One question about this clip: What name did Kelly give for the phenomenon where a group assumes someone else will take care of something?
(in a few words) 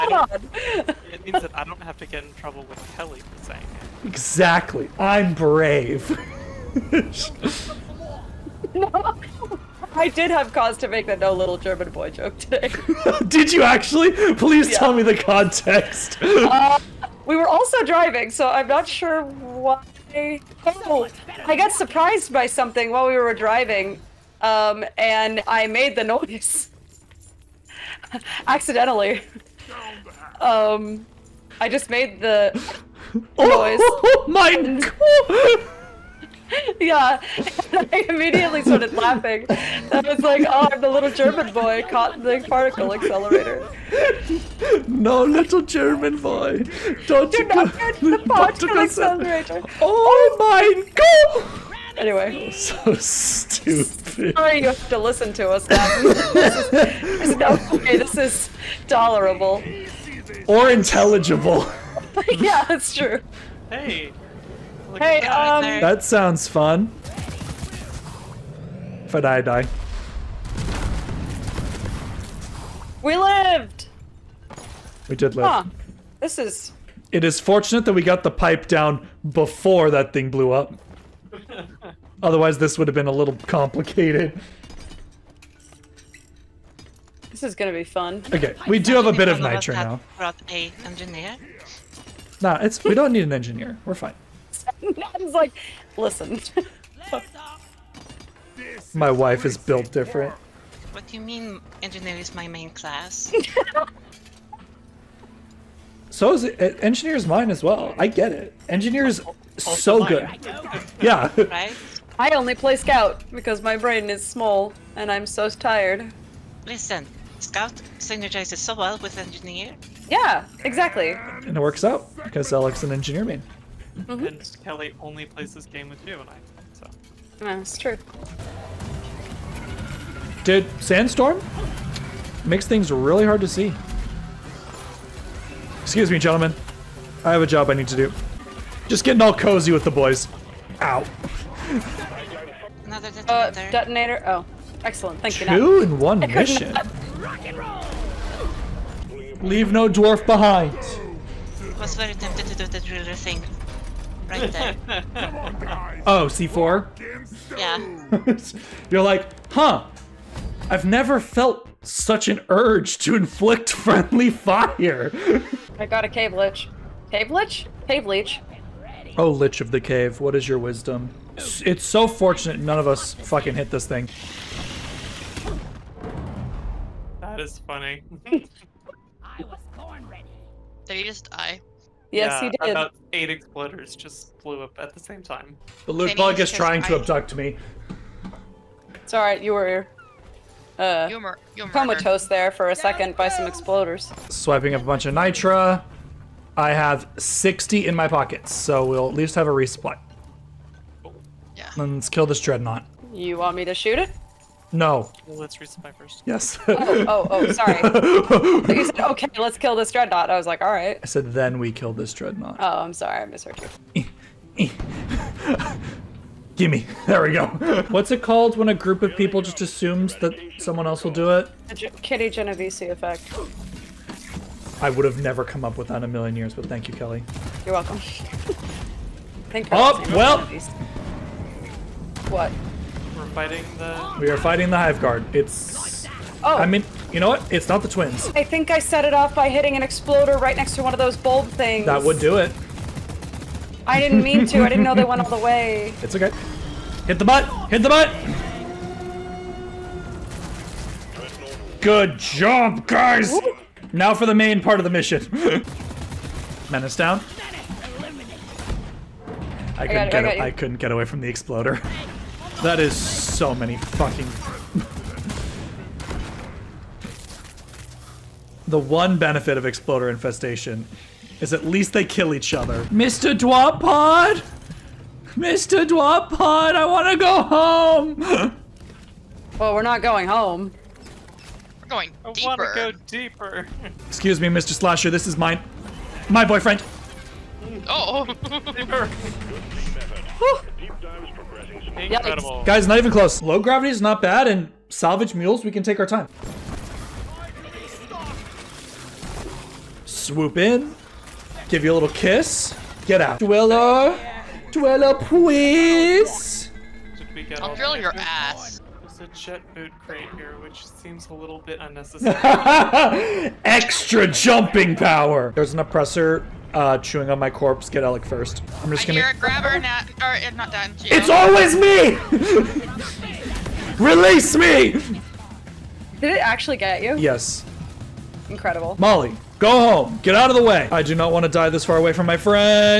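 Kitty Genovese effect.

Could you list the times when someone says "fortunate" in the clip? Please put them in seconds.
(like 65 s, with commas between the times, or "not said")
77 s, 172 s.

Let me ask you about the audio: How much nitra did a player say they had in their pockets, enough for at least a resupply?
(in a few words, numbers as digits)
60.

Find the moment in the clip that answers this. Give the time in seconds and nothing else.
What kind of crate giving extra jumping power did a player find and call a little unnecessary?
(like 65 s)
309 s.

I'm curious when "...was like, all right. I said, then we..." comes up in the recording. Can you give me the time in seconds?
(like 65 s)
210 s.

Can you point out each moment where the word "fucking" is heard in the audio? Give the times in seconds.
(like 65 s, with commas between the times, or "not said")
173 s, 263 s.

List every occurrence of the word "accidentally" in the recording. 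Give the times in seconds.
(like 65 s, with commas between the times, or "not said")
28 s.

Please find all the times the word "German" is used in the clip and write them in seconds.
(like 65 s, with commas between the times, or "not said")
11 s, 41 s, 45 s.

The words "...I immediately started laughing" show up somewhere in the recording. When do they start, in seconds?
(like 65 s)
37 s.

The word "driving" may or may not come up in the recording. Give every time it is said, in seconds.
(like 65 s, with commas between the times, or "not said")
17 s, 23 s.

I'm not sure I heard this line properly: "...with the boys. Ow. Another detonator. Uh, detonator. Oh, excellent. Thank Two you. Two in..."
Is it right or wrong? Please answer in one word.
right.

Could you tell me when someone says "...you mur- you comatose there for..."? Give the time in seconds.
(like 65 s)
191 s.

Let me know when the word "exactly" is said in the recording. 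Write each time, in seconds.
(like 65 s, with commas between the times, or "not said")
4 s, 120 s.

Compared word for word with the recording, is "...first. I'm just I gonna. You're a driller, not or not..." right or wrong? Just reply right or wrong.
wrong.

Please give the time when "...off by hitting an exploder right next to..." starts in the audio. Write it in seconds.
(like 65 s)
239 s.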